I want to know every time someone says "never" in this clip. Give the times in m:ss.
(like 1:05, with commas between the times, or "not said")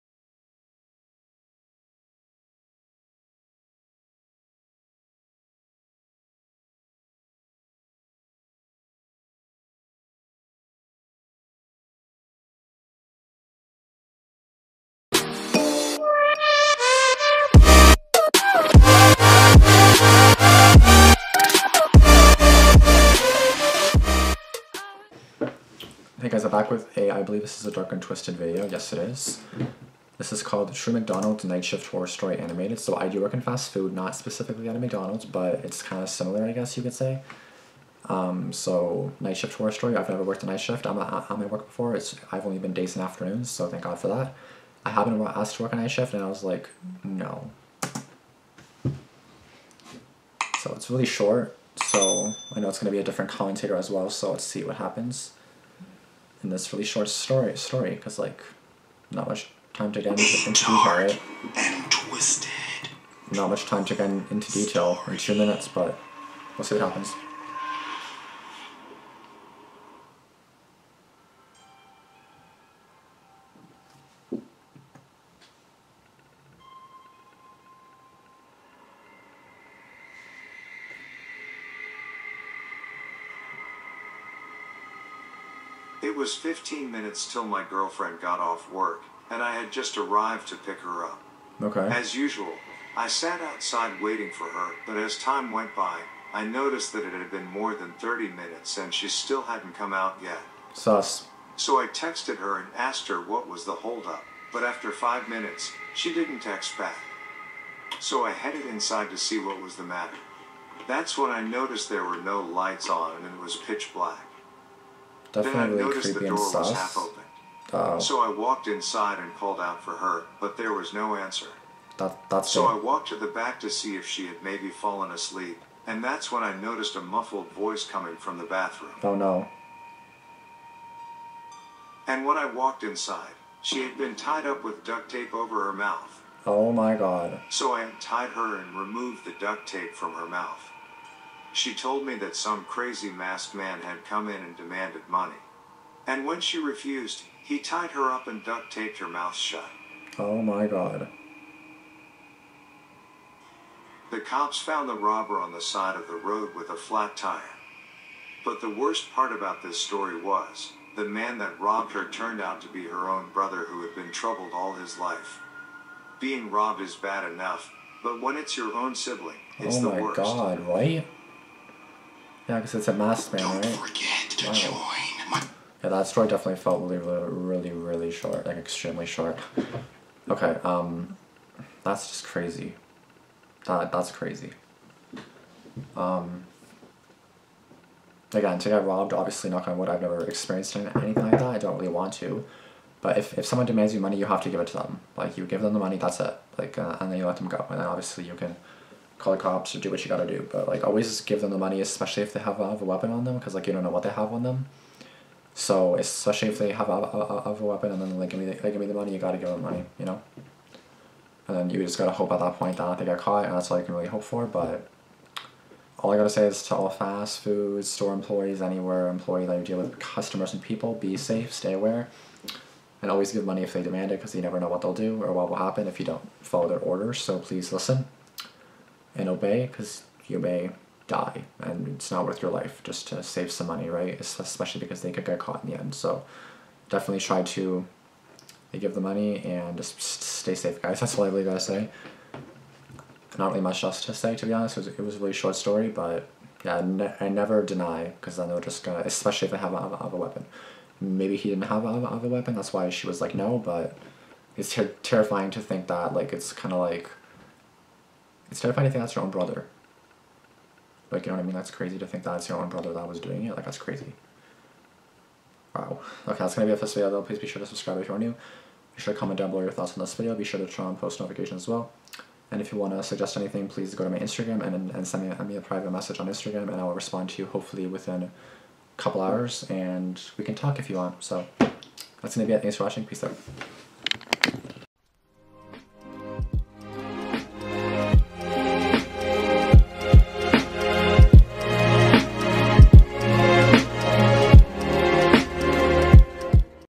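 0:40, 3:10, 3:44, 4:07.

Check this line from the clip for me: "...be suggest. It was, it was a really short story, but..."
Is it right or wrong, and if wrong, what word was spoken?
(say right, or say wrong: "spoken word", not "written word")
wrong: "honest", not "suggest".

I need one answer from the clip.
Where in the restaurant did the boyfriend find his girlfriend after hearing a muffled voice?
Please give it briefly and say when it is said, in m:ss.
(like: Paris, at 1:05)
The bathroom, at 2:08.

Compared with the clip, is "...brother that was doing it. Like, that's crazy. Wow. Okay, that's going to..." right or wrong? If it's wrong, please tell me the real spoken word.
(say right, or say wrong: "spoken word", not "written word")
right.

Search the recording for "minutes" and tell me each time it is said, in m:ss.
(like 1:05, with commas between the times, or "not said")
1:05, 1:26, 1:38, 1:45.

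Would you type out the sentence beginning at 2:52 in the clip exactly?
Yeah, because it's a masked man, Don't right?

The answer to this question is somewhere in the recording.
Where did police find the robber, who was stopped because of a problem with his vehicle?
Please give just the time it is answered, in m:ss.
2:35.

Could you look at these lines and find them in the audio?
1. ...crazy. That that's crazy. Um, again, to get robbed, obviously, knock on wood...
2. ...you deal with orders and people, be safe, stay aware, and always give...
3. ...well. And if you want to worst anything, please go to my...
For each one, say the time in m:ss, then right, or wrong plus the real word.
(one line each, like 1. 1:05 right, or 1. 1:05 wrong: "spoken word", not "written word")
1. 3:02 right
2. 3:39 wrong: "customers", not "orders"
3. 4:31 wrong: "suggest", not "worst".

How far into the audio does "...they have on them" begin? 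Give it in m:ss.
3:24.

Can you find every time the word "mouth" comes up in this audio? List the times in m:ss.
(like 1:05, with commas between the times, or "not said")
2:15, 2:20, 2:29.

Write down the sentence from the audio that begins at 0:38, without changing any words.
Um, so night shift horror story.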